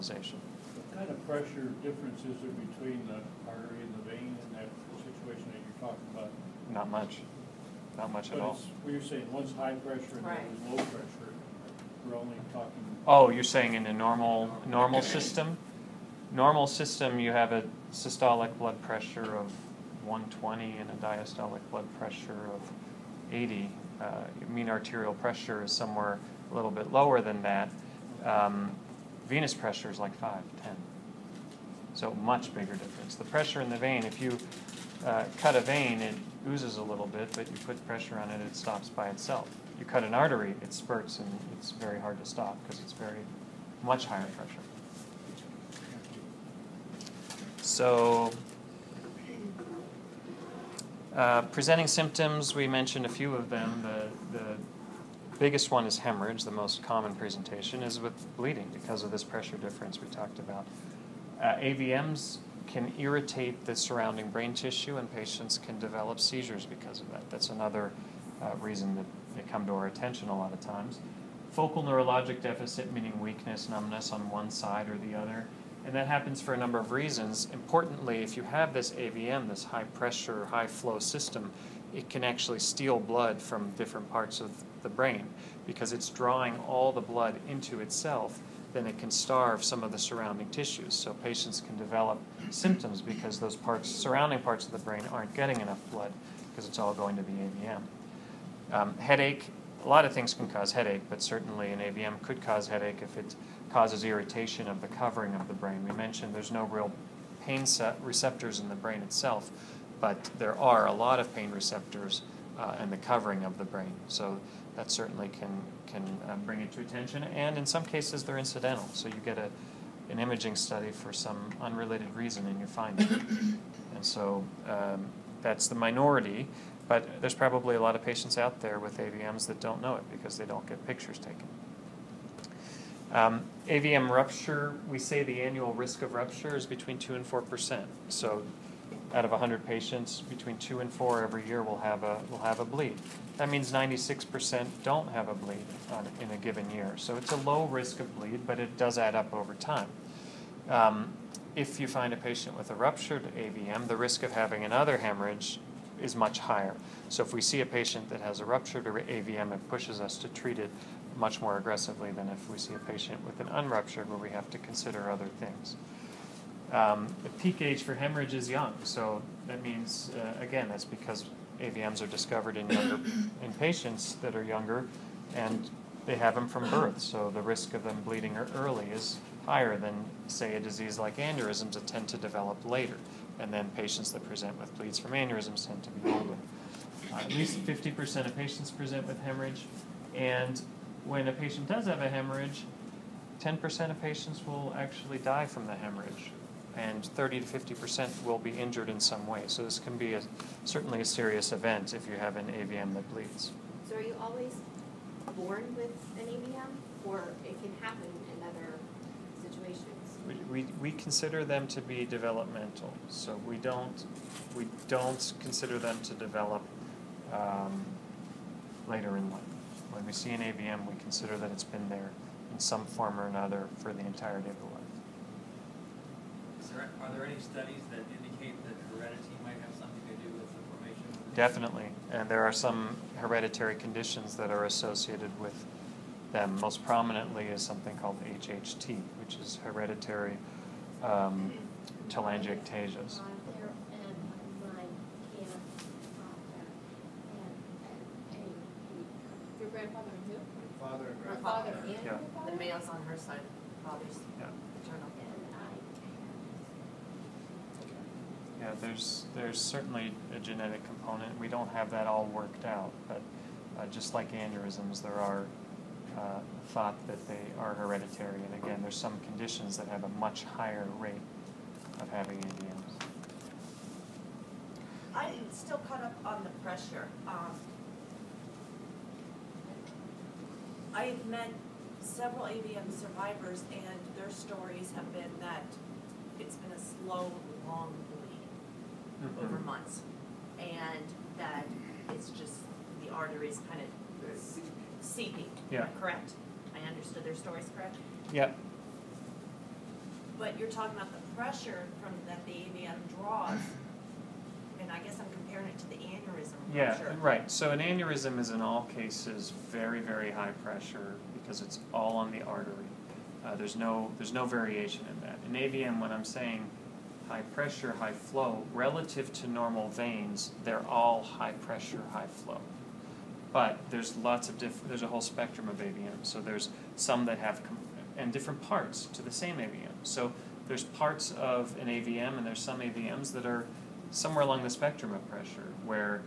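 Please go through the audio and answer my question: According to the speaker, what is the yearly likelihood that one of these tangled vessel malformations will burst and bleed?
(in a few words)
2 to 4%.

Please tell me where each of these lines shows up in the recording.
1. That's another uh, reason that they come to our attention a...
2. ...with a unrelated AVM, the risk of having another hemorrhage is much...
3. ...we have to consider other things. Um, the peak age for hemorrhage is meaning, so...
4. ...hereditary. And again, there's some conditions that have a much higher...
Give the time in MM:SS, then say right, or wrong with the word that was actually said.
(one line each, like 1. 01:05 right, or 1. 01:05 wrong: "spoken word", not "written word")
1. 01:07 right
2. 02:32 wrong: "ruptured", not "unrelated"
3. 02:44 wrong: "young", not "meaning"
4. 04:27 right.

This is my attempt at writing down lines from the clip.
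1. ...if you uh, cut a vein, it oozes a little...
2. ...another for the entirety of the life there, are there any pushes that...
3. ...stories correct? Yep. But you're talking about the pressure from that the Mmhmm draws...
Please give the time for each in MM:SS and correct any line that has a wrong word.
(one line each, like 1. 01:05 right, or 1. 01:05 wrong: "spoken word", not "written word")
1. 00:34 right
2. 03:43 wrong: "studies", not "pushes"
3. 04:57 wrong: "AVM", not "Mmhmm".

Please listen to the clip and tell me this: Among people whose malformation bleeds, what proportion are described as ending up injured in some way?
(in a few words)
30 to 50 percent.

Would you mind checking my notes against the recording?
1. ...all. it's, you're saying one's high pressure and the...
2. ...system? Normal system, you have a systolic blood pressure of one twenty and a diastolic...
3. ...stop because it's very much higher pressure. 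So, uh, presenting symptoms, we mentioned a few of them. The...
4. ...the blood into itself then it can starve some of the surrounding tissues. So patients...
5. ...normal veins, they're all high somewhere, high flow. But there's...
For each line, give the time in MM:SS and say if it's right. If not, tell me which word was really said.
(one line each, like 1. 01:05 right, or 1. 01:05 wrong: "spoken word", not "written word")
1. 00:08 right
2. 00:15 right
3. 00:42 right
4. 01:26 right
5. 05:19 wrong: "pressure", not "somewhere".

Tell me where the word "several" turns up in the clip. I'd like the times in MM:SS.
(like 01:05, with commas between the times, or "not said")
04:41.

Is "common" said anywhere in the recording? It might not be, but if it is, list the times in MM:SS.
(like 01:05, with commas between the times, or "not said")
00:56.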